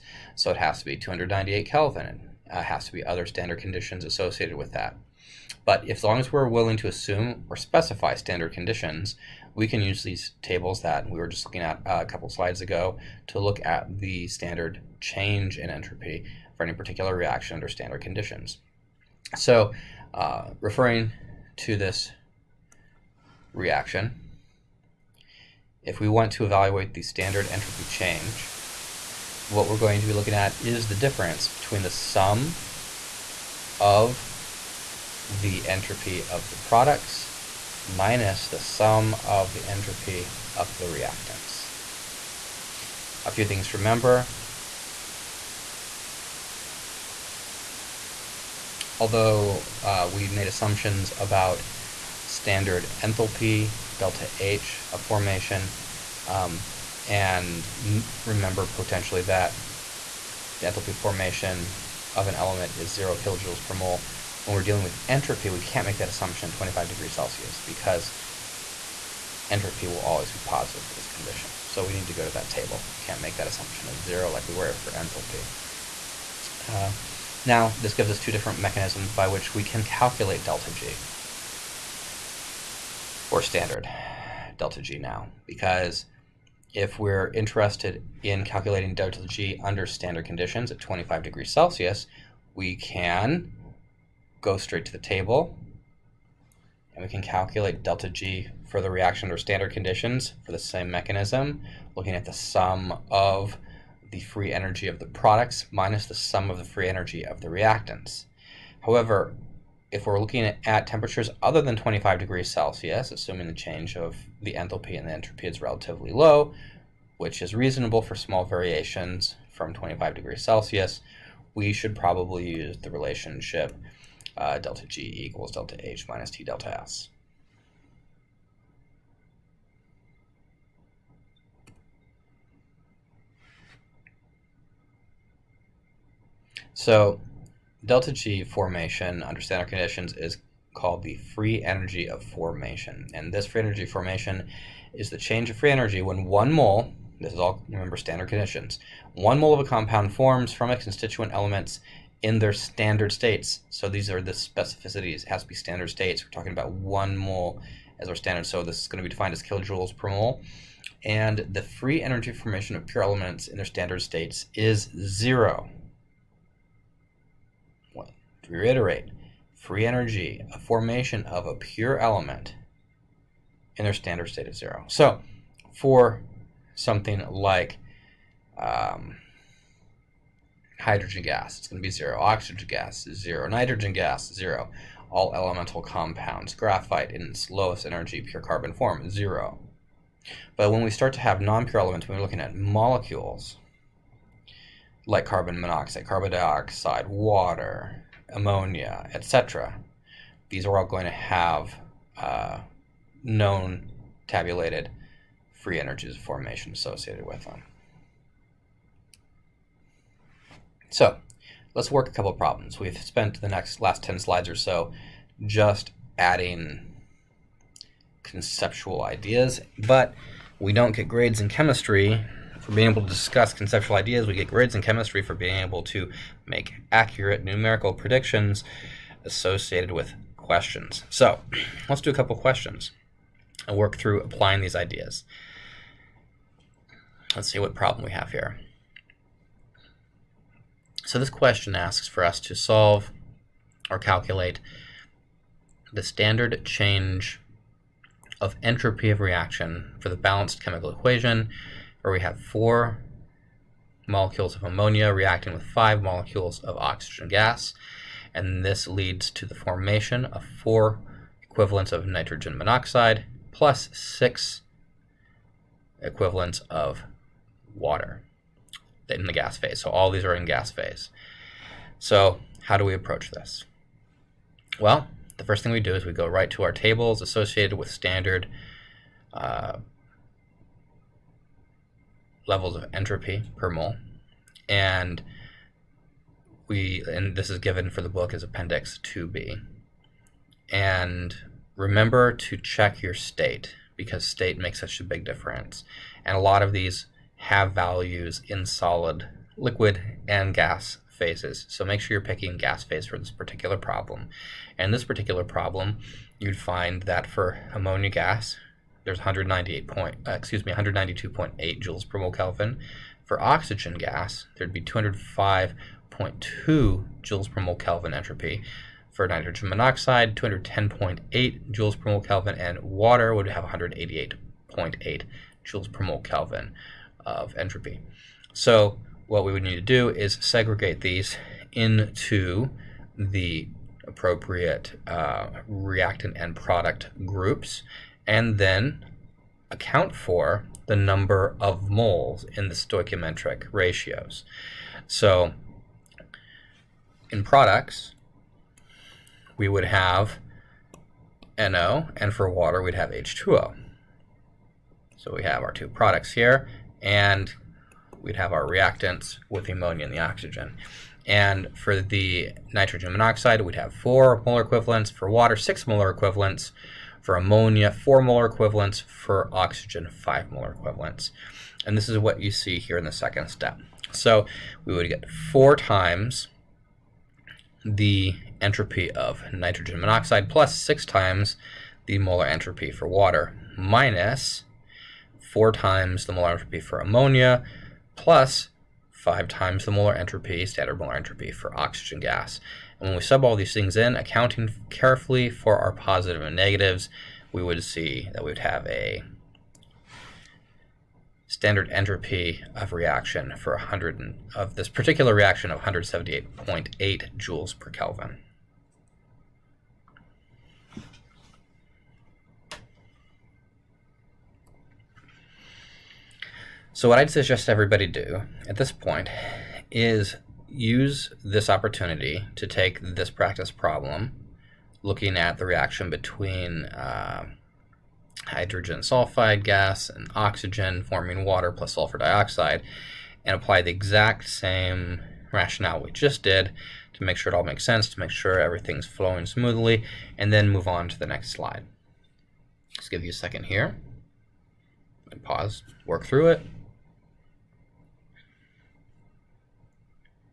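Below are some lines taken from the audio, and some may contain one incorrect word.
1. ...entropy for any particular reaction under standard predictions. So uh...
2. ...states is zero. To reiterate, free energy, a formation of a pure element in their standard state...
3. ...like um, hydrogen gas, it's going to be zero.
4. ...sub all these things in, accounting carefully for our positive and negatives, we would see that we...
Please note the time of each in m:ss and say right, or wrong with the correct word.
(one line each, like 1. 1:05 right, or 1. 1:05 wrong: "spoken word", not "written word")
1. 0:15 wrong: "conditions", not "predictions"
2. 2:43 right
3. 2:57 right
4. 6:33 right.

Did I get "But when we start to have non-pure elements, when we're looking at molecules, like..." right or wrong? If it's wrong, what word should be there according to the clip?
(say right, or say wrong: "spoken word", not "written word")
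right.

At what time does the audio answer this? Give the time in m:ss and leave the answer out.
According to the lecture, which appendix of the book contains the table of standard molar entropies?
4:48.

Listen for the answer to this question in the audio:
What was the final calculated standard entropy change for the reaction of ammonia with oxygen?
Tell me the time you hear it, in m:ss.
6:45.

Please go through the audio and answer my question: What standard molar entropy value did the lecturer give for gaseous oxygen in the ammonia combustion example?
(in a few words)
205.2 J/(mol·K).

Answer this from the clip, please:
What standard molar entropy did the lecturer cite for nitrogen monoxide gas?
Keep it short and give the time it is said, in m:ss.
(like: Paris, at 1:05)
210.8 J/(mol·K), at 5:20.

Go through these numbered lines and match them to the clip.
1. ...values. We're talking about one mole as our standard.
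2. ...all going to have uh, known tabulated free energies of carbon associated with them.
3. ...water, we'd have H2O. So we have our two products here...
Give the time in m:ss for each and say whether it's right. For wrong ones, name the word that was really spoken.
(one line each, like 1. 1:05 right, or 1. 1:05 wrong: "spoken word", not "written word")
1. 2:35 wrong: "states", not "values"
2. 3:20 wrong: "formation", not "carbon"
3. 5:52 right.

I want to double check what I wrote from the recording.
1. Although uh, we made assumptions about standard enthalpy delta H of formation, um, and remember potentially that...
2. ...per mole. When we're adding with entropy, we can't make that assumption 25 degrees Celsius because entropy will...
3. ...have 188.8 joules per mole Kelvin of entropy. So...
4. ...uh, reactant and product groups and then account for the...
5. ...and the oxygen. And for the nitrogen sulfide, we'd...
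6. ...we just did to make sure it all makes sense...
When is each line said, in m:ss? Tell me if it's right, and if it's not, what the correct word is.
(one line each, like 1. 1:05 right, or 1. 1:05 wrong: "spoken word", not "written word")
1. 0:48 right
2. 1:03 wrong: "dealing", not "adding"
3. 5:23 right
4. 5:35 right
5. 6:00 wrong: "monoxide", not "sulfide"
6. 7:16 right.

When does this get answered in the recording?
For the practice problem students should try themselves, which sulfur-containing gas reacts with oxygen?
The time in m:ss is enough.
7:08.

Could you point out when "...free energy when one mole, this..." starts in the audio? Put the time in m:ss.
2:25.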